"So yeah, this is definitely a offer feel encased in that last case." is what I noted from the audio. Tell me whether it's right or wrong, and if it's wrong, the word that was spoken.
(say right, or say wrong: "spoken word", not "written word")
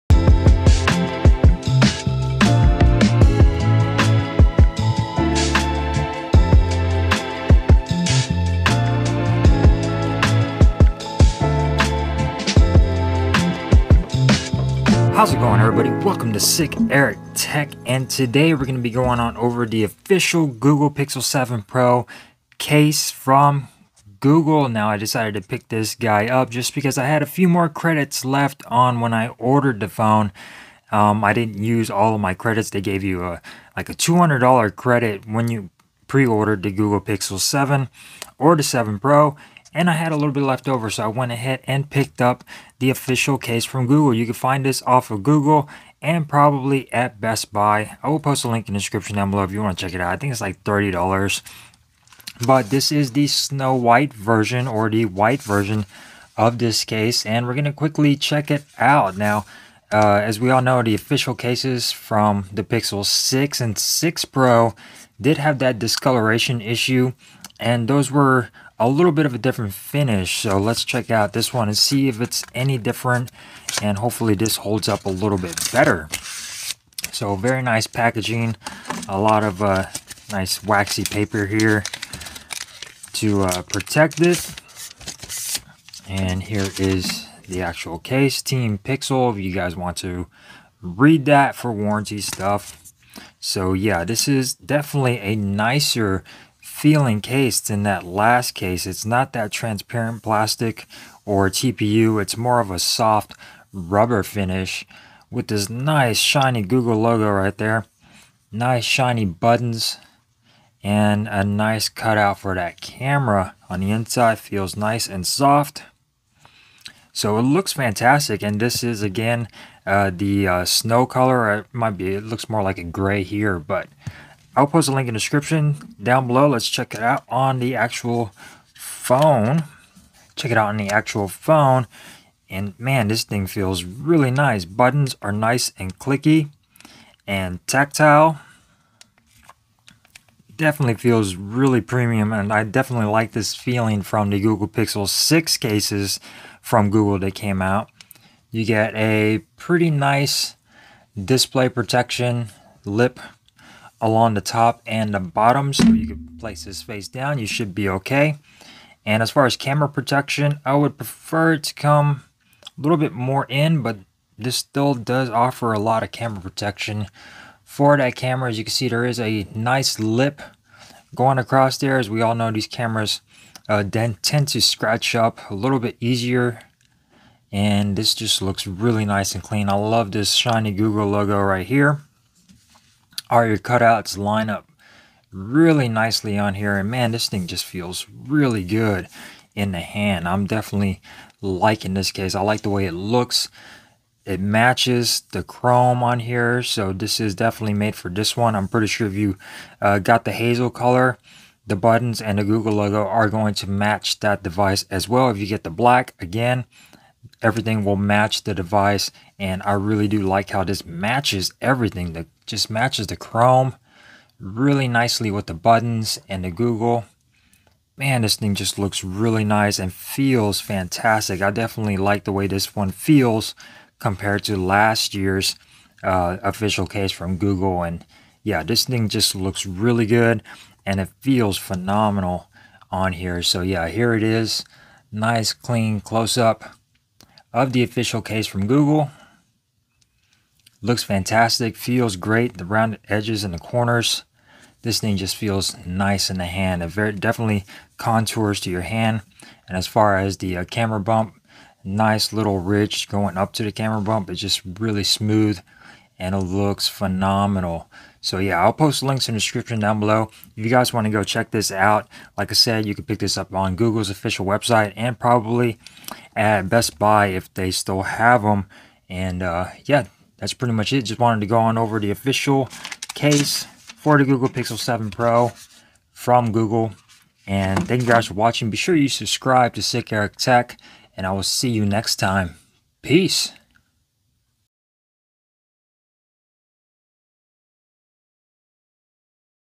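wrong: "nicer", not "offer".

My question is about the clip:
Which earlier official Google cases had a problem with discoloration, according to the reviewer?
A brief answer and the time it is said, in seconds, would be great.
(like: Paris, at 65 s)
Pixel 6 and 6 Pro, at 62 s.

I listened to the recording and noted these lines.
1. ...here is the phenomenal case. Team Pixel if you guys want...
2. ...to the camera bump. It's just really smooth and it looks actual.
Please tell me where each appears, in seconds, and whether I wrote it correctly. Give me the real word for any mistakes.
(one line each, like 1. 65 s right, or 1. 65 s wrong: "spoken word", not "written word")
1. 86 s wrong: "actual", not "phenomenal"
2. 253 s wrong: "phenomenal", not "actual".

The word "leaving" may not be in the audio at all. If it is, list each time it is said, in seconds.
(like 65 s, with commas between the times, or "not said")
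not said.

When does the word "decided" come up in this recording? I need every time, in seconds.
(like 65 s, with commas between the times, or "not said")
24 s.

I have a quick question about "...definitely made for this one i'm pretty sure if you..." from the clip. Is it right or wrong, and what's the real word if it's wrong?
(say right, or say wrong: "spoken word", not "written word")
right.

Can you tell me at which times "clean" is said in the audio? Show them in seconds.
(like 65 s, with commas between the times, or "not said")
179 s, 235 s.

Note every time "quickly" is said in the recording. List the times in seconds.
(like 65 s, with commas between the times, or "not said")
57 s.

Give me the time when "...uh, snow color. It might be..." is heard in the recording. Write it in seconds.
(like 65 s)
120 s.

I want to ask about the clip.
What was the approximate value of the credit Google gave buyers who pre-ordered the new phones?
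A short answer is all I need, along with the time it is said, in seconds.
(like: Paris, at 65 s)
$200, at 33 s.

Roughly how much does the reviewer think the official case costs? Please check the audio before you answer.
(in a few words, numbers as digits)
$30.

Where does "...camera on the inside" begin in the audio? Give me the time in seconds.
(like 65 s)
112 s.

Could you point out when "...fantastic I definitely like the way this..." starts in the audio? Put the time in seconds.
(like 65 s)
220 s.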